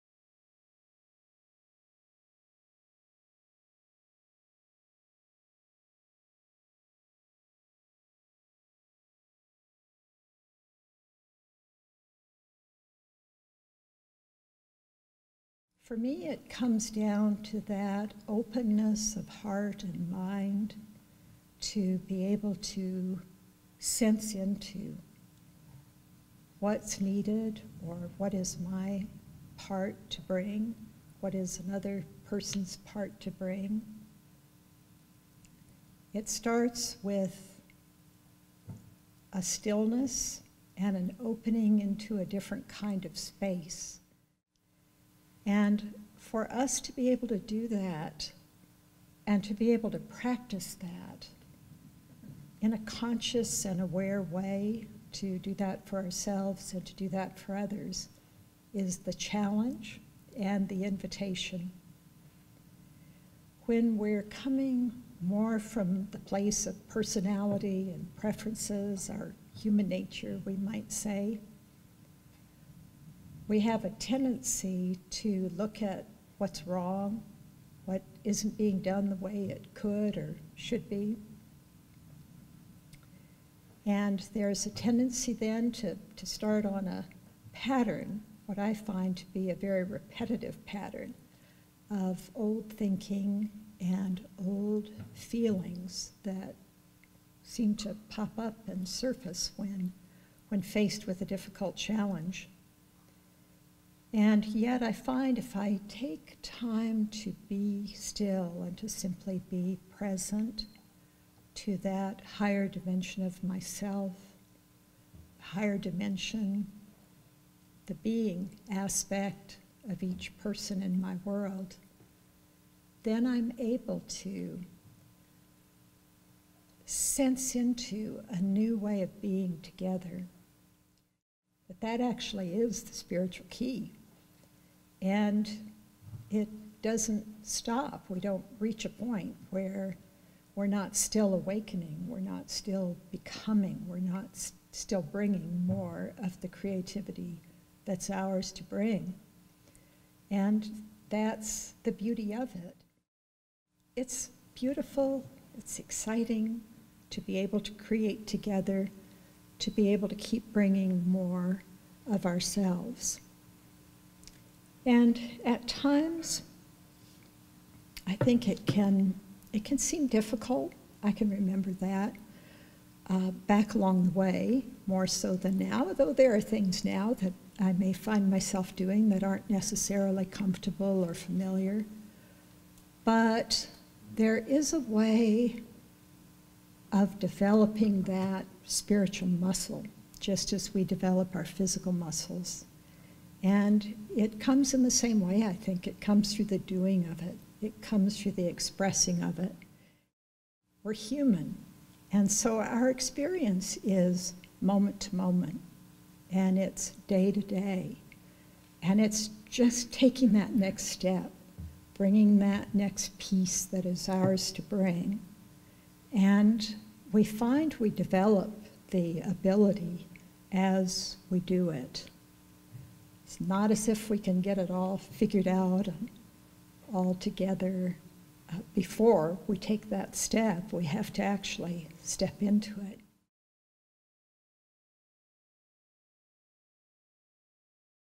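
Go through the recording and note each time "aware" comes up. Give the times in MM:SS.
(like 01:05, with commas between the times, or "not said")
00:53.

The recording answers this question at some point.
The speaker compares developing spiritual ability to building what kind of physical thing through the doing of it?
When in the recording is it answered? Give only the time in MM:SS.
03:11.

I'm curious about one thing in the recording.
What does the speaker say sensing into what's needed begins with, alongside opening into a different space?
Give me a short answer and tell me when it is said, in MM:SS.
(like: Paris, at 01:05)
A stillness, at 00:39.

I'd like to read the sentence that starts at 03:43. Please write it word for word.
It's not as if we can get it all figured out and all together.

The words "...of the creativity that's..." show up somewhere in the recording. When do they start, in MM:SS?
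02:26.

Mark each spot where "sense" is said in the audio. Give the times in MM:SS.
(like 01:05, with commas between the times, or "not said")
00:23, 02:06.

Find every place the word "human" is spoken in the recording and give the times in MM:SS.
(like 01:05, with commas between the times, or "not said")
01:09, 03:20.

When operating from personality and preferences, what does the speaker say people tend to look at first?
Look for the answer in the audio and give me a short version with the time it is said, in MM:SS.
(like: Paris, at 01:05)
What's wrong, at 01:16.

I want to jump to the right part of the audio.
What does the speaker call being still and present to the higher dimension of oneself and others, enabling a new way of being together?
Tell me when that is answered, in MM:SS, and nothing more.
02:12.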